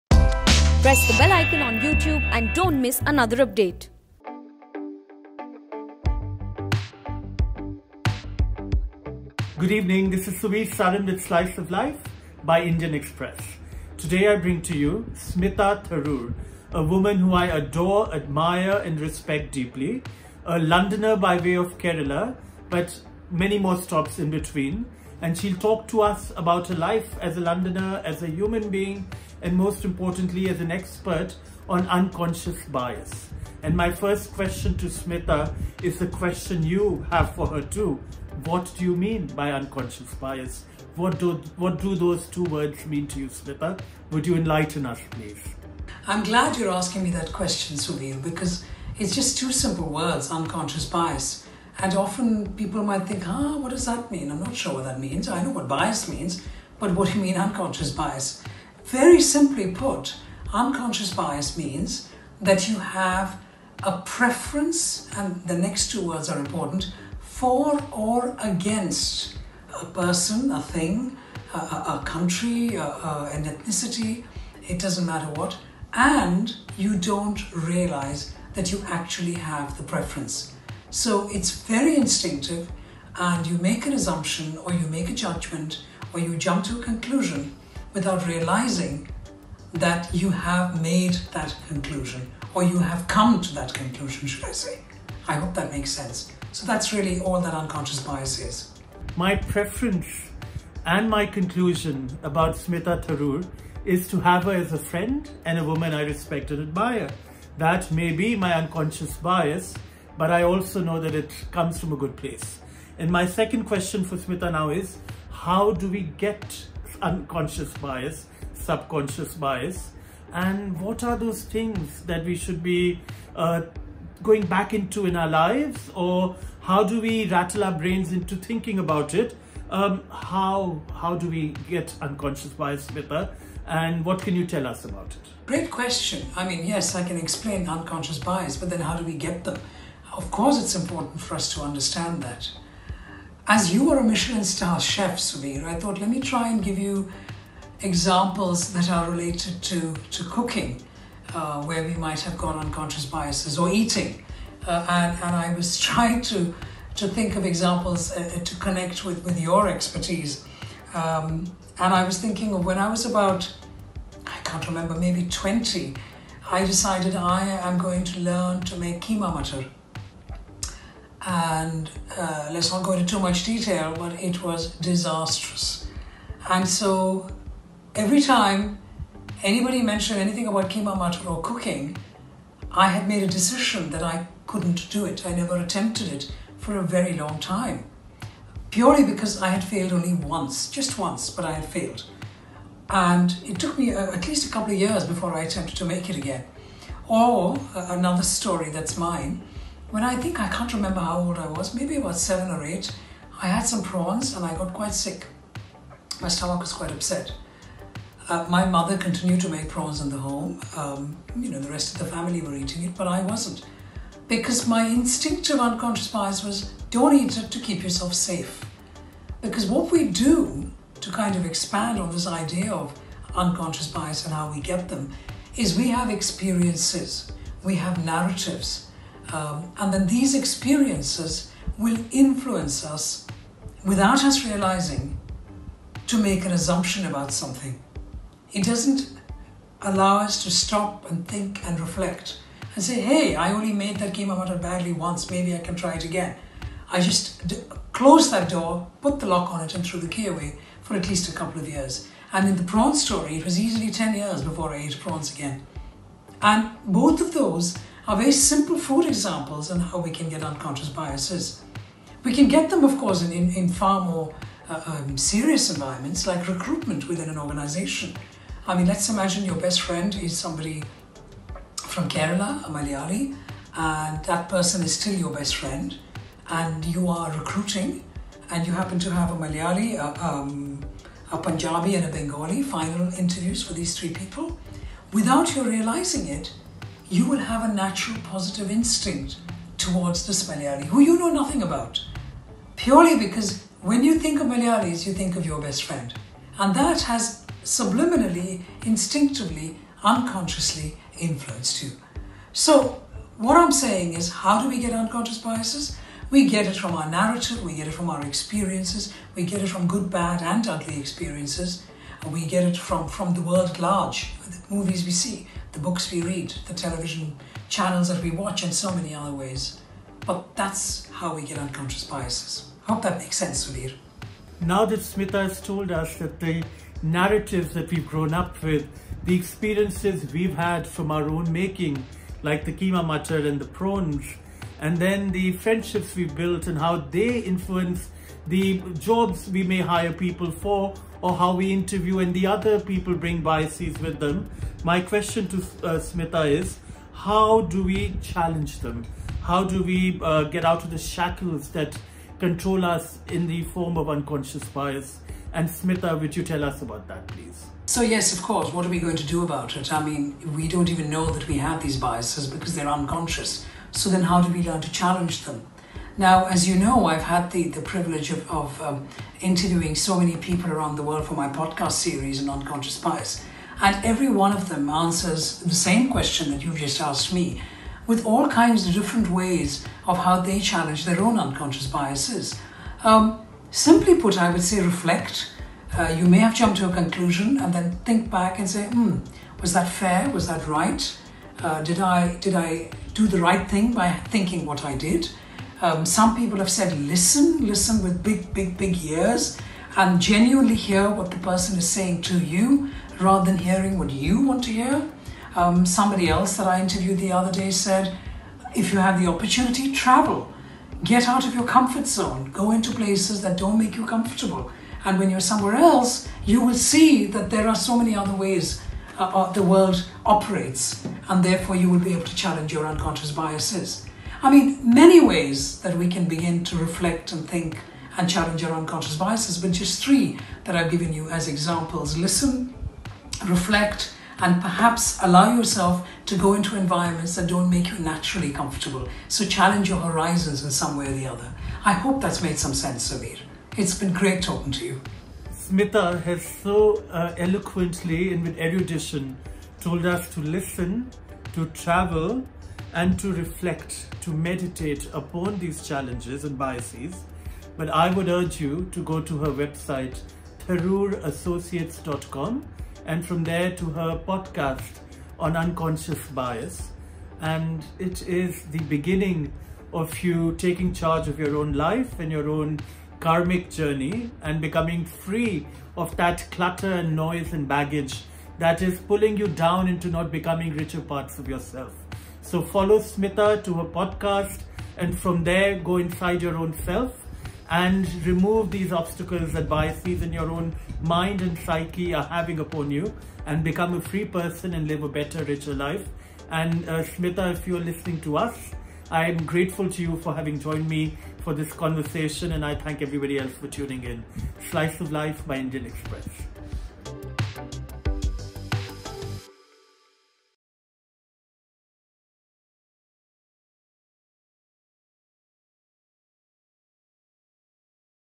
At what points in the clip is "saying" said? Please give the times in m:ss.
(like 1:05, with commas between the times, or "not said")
5:03, 6:41.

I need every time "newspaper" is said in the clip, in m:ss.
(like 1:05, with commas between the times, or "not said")
not said.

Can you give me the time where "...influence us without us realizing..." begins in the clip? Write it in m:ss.
3:52.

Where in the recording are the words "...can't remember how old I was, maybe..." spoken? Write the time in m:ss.
3:20.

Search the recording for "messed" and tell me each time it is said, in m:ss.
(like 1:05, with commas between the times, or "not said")
not said.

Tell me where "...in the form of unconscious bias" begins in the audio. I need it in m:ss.
5:53.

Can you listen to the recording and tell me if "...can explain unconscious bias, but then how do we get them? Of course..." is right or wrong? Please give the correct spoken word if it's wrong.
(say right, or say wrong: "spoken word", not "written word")
right.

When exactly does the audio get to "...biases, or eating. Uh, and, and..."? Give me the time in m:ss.
2:33.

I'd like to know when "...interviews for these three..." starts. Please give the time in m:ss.
4:43.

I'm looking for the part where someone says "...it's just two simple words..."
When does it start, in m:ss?
0:48.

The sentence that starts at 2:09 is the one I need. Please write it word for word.
Um, how, how do we get unconscious bias better?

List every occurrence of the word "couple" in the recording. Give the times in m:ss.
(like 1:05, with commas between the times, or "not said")
3:14, 4:11.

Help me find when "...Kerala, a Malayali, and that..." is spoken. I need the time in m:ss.
4:32.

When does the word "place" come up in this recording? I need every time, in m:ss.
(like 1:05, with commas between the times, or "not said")
1:52, 6:52.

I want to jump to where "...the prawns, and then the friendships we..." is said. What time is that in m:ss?
5:33.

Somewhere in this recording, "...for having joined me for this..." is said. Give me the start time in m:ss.
8:20.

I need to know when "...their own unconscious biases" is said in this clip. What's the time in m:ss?
6:21.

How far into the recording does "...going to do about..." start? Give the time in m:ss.
5:58.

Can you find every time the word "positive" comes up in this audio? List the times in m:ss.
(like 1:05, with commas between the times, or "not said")
4:48.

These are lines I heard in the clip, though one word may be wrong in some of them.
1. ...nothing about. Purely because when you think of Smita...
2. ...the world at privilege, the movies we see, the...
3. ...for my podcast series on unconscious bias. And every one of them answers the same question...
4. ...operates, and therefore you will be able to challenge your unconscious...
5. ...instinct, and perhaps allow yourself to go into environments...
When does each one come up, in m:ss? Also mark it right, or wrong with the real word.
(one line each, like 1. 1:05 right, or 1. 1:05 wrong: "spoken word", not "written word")
1. 4:51 wrong: "Malayalis", not "Smita"
2. 5:13 wrong: "large", not "privilege"
3. 6:11 right
4. 7:00 right
5. 7:13 wrong: "reflect", not "instinct".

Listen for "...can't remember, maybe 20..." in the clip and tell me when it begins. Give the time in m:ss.
2:44.